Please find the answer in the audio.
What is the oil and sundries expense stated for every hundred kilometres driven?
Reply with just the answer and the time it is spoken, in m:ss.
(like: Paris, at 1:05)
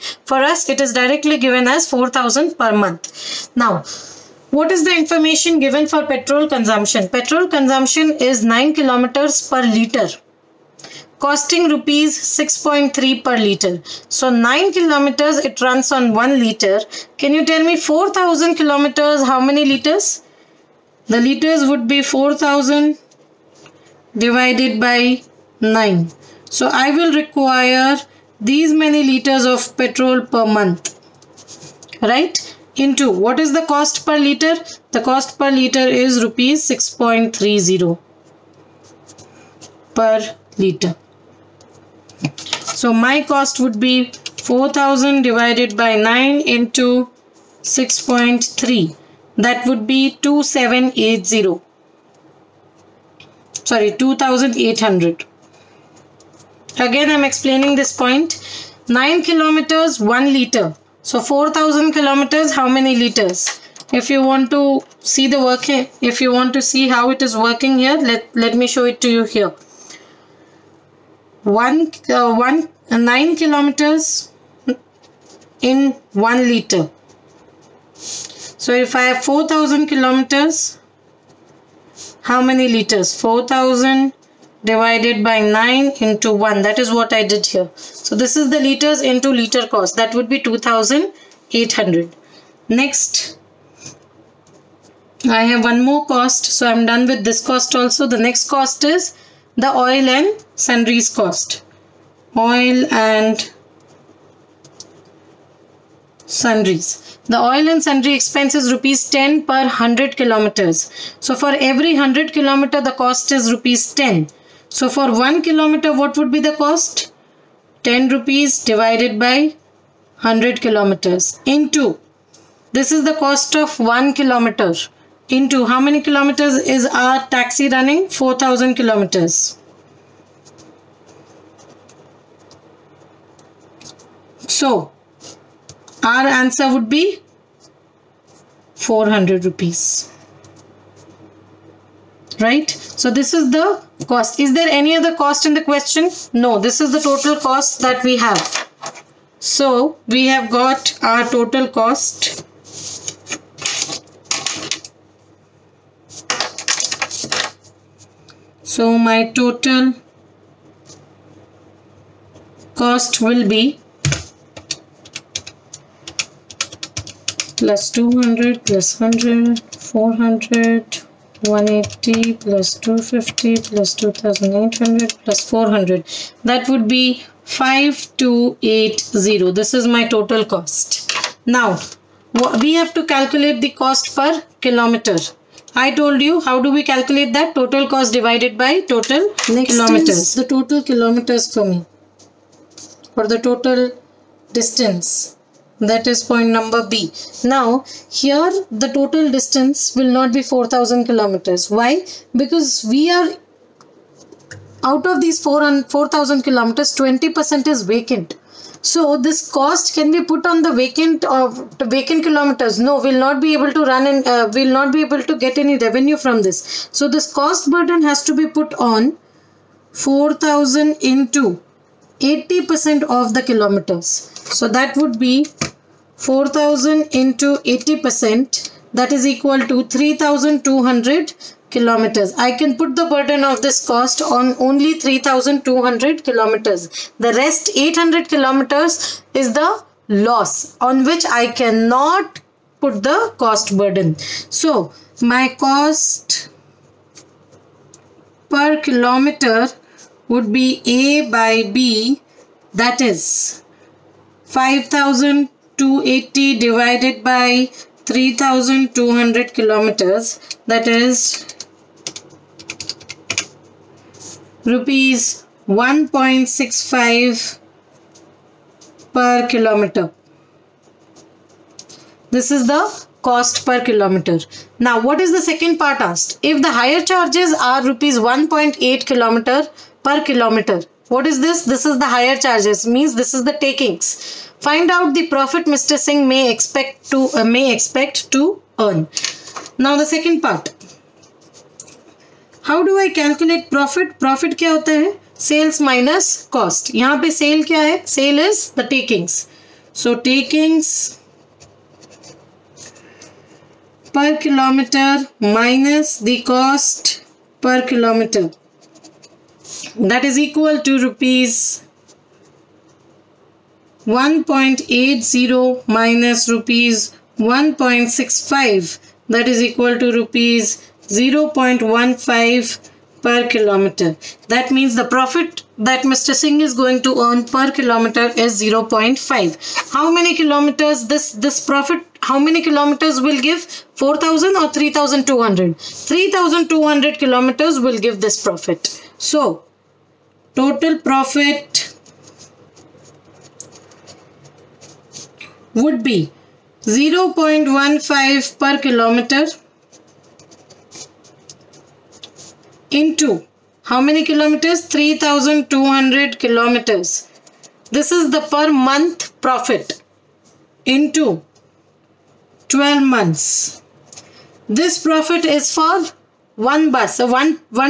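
Rs 10, at 1:48.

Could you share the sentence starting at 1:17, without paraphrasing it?
So if I have 4000 kilometers, how many liters?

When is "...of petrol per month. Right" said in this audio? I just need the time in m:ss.
0:29.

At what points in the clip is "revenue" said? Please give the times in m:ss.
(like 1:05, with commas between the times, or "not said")
3:35.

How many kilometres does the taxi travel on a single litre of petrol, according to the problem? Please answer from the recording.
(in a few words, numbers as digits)
9.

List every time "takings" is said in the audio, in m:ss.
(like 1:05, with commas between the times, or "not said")
4:43.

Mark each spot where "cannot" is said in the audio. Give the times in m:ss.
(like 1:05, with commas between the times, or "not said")
4:01.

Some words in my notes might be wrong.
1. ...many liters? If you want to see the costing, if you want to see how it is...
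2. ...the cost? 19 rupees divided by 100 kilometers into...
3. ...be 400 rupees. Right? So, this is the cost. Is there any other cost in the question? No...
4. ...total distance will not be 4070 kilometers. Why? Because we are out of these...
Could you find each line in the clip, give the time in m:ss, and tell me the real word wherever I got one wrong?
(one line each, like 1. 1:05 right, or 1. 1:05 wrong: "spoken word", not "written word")
1. 1:02 wrong: "working", not "costing"
2. 1:56 wrong: "10", not "19"
3. 2:16 right
4. 3:18 wrong: "4000", not "4070".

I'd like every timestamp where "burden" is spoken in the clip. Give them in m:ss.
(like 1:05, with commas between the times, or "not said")
3:37, 3:53, 4:03.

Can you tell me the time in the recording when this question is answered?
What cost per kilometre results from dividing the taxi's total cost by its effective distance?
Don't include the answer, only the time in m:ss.
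4:24.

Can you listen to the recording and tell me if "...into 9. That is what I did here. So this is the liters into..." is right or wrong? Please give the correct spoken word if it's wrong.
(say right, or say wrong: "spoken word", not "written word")
wrong: "1", not "9".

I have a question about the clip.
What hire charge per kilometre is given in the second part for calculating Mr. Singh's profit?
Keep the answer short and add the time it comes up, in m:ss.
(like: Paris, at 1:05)
Rs 1.80, at 4:37.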